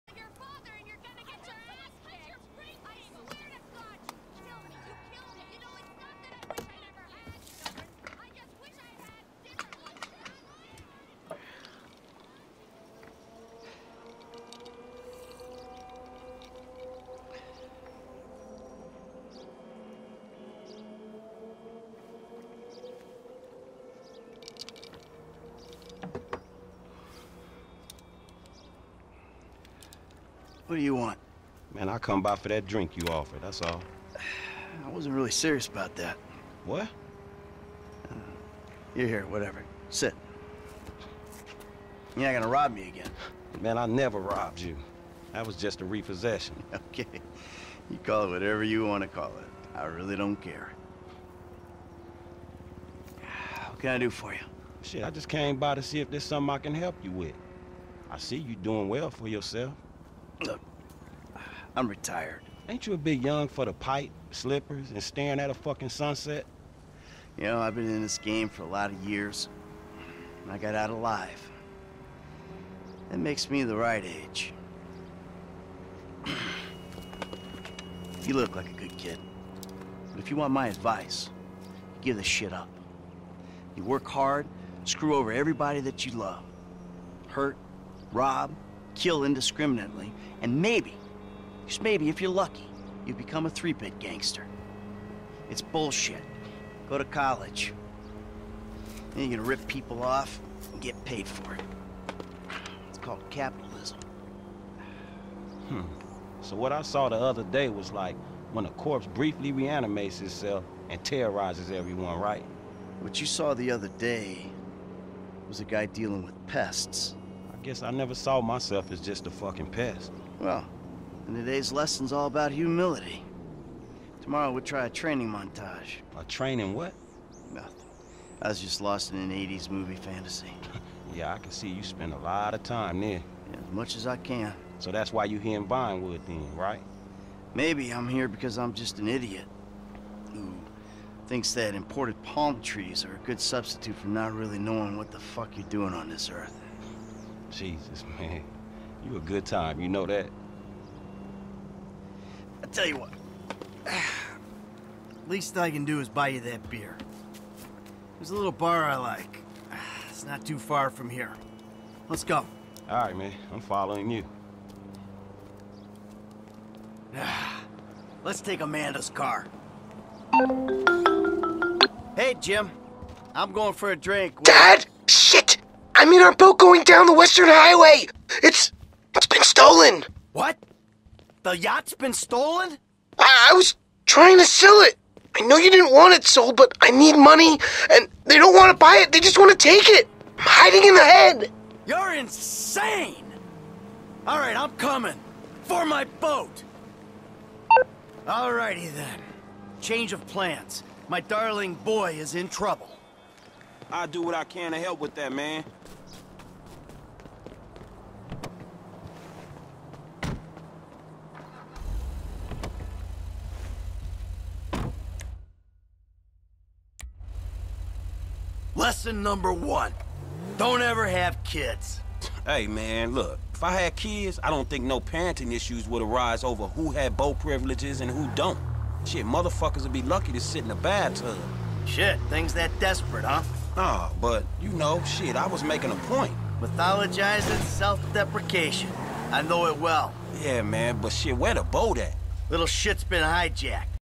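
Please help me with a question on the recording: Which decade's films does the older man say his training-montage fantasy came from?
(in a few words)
The 80s.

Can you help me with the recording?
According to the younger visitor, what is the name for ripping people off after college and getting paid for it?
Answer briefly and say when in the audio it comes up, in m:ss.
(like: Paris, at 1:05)
Capitalism, at 1:43.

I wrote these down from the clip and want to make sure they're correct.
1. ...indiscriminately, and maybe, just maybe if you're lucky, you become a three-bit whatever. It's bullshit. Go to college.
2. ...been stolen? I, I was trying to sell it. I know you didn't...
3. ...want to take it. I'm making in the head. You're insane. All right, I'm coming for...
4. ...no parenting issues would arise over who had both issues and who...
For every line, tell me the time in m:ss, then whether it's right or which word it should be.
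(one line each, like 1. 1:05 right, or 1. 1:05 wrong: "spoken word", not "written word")
1. 1:29 wrong: "gangster", not "whatever"
2. 3:01 right
3. 3:09 wrong: "hiding", not "making"
4. 3:44 wrong: "privileges", not "issues".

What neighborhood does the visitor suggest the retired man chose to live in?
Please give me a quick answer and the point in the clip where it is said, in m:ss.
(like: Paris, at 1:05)
Vinewood, at 2:15.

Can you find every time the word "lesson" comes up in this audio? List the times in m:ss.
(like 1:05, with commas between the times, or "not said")
2:01, 3:38.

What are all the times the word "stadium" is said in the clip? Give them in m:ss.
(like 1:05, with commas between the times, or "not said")
not said.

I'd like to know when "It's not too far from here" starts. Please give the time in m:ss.
2:40.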